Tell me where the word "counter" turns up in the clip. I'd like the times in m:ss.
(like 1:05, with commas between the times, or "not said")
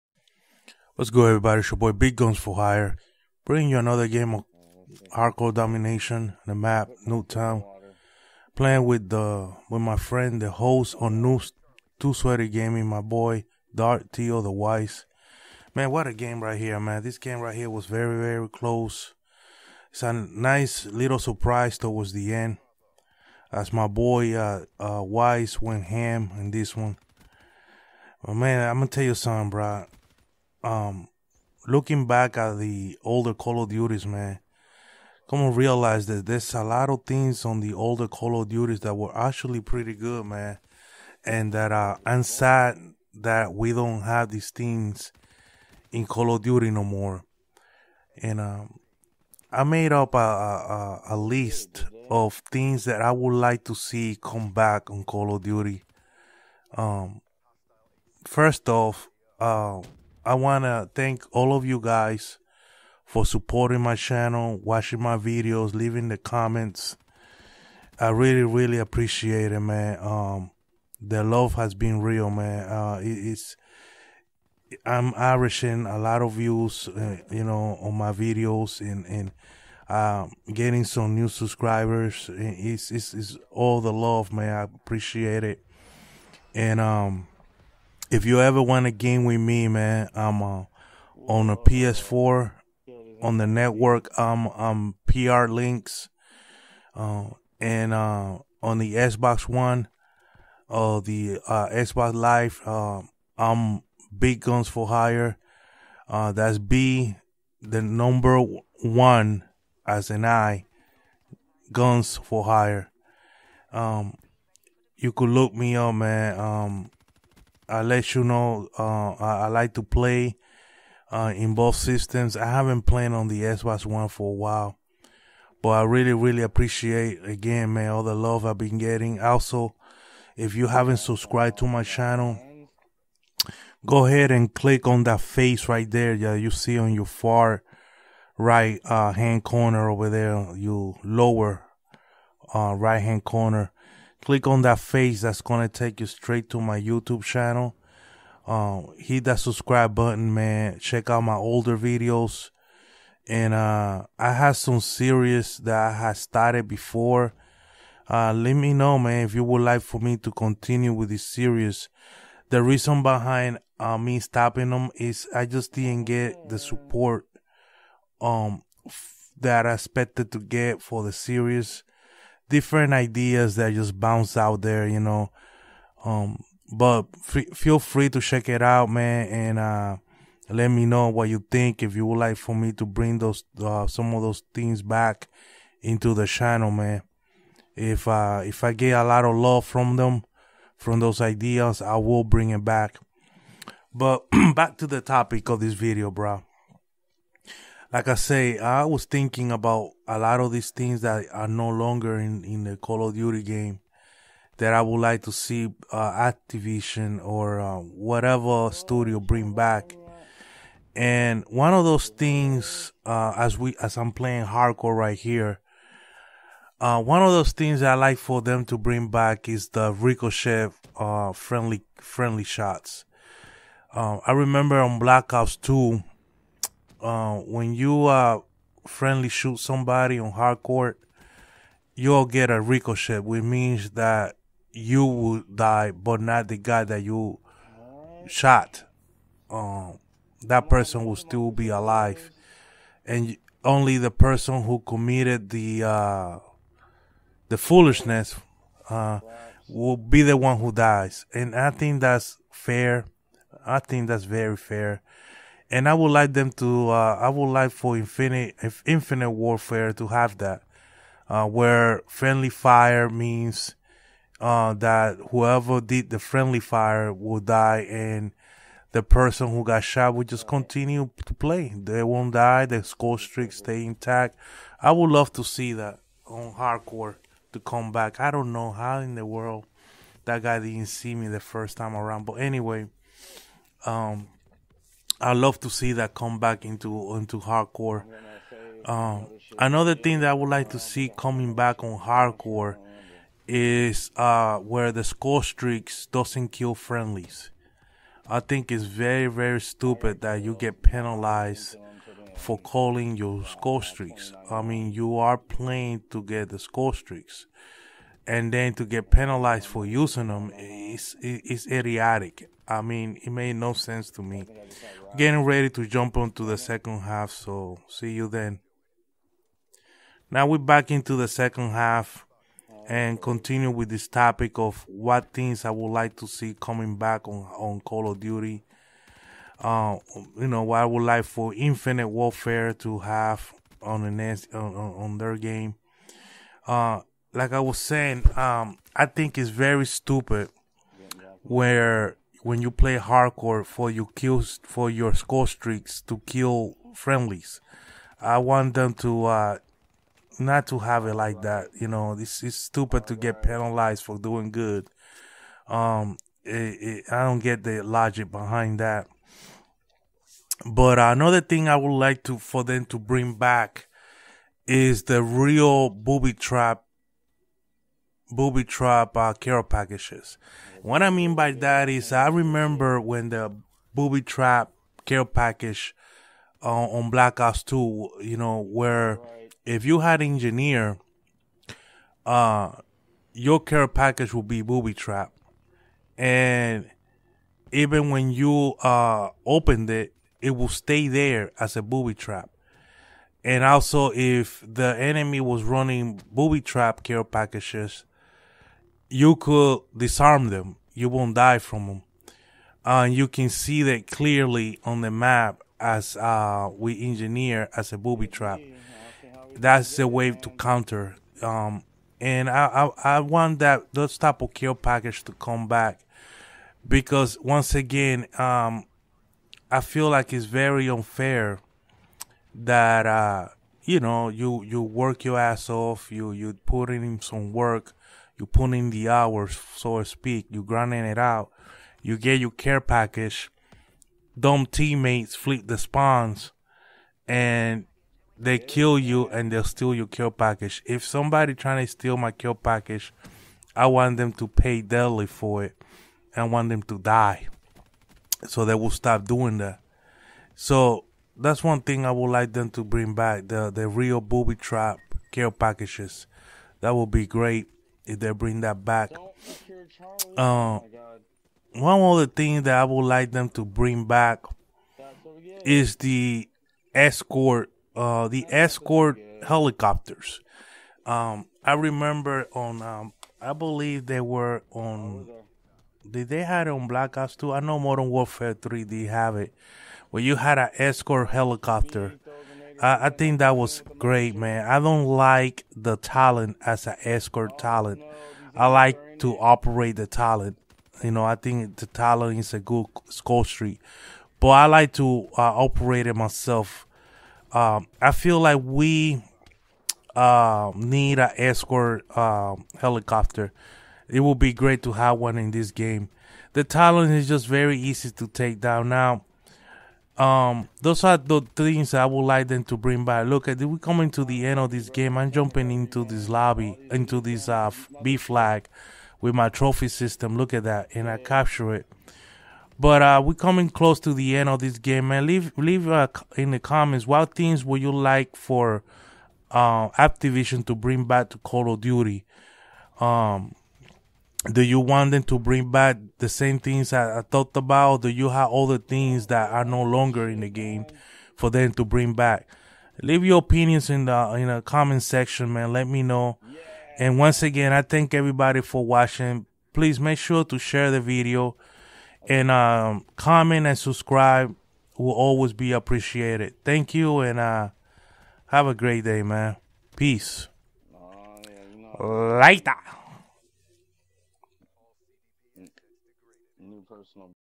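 6:50.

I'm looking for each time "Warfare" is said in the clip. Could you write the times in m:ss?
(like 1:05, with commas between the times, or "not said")
4:19, 5:32, 7:58.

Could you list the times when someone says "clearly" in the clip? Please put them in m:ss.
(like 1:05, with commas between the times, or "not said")
6:44.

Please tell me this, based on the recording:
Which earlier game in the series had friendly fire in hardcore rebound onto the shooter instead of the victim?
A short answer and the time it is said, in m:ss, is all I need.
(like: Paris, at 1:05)
Black Ops 2, at 3:44.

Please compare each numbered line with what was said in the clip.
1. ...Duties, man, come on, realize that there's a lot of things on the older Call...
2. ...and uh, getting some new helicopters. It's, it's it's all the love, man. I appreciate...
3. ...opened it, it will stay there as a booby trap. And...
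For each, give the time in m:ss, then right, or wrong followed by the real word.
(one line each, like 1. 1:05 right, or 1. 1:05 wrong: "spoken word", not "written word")
1. 0:33 right
2. 1:19 wrong: "subscribers", not "helicopters"
3. 6:29 right.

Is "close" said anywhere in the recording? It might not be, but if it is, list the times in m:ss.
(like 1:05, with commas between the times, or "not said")
0:18, 8:43.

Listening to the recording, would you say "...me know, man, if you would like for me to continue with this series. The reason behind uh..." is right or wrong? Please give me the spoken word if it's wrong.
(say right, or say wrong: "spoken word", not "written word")
right.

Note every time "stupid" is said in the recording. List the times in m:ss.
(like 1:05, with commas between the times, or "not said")
4:59, 5:39, 5:52.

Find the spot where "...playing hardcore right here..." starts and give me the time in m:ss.
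3:34.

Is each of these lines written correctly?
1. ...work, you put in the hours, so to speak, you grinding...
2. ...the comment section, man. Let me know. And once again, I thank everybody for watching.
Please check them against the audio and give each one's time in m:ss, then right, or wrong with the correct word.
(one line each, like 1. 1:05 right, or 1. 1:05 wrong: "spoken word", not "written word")
1. 7:07 right
2. 9:04 right.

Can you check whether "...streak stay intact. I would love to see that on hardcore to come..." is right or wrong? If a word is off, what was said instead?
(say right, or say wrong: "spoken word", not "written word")
right.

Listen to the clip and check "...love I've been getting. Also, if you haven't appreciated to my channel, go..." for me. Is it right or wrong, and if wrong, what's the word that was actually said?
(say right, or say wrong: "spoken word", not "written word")
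wrong: "subscribed", not "appreciated".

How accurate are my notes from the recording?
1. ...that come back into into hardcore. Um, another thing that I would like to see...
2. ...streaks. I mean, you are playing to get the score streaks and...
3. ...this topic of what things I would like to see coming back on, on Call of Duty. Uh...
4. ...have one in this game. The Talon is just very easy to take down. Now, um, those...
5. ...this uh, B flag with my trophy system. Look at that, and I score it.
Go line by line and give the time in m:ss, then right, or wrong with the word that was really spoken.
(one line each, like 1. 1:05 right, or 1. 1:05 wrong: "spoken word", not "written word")
1. 4:45 right
2. 5:03 right
3. 5:23 right
4. 8:24 right
5. 8:37 wrong: "capture", not "score".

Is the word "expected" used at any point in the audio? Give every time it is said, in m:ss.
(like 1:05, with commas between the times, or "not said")
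2:49.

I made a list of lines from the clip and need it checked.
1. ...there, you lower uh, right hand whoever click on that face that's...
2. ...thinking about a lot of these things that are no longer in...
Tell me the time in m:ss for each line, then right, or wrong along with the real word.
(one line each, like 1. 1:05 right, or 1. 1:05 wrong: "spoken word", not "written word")
1. 2:20 wrong: "corner", not "whoever"
2. 3:19 right.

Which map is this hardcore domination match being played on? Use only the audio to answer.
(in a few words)
Nuketown.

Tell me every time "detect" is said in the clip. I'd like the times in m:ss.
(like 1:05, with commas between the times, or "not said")
not said.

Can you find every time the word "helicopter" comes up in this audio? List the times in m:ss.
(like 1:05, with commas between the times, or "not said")
7:49, 8:01, 8:22.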